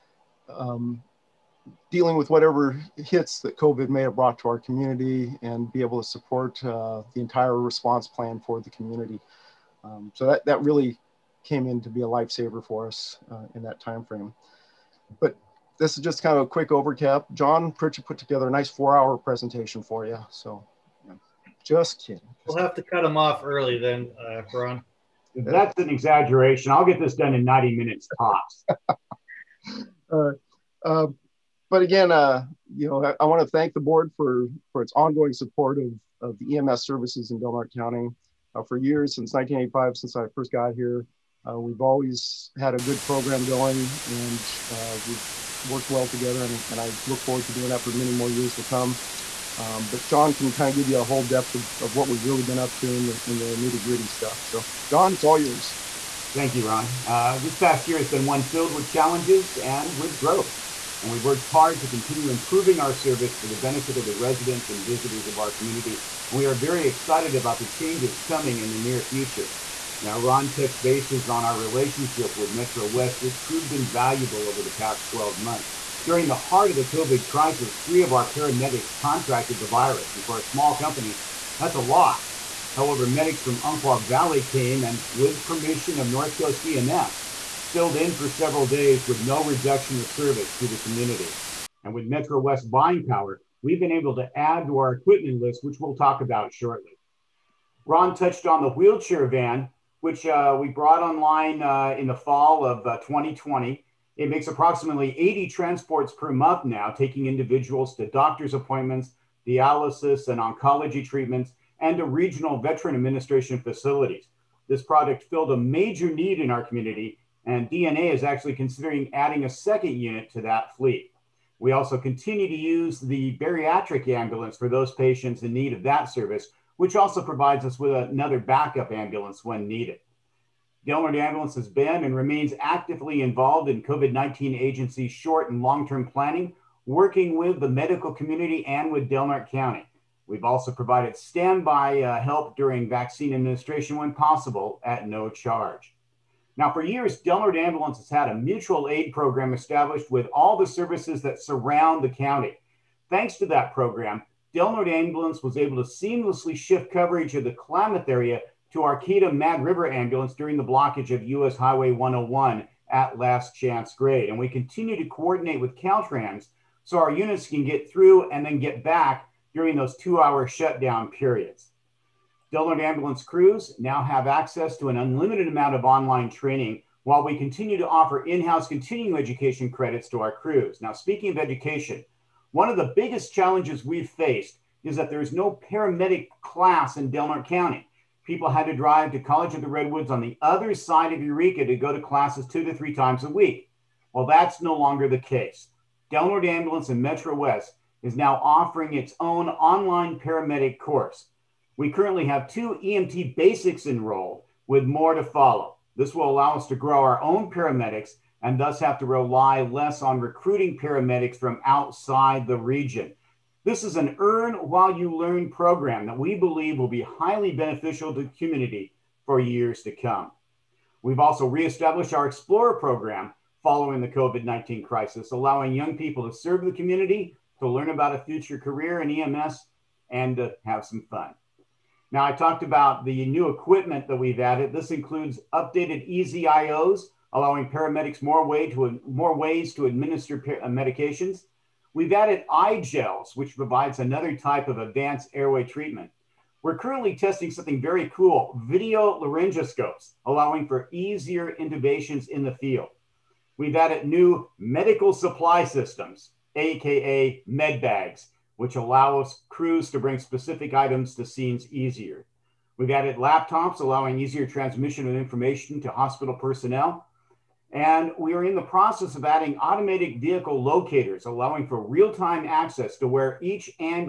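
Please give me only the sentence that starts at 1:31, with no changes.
And with Metro West buying power, we've been able to add to our equipment list, which we'll talk about shortly.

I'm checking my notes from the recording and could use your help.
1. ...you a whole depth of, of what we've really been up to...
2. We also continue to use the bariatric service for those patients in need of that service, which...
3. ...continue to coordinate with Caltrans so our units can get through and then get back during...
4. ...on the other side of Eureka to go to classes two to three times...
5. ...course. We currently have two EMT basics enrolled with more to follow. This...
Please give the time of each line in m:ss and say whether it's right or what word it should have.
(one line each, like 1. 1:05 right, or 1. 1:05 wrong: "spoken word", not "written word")
1. 0:50 right
2. 2:01 wrong: "ambulance", not "service"
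3. 2:44 right
4. 3:10 right
5. 3:20 right.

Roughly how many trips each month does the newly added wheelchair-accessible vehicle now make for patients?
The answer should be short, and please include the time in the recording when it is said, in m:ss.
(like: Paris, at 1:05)
80, at 1:45.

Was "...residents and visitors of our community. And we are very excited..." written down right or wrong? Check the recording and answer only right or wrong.
right.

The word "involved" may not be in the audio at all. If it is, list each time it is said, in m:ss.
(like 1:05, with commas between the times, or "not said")
2:13.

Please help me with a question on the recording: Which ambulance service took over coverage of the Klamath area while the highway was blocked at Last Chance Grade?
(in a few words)
Arcata Mad River Ambulance.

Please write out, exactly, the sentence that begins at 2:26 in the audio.
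Now, for years, Del Norte Ambulance has had a mutual aid program established with all the services that surround the county.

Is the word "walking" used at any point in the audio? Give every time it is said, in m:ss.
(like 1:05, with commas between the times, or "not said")
not said.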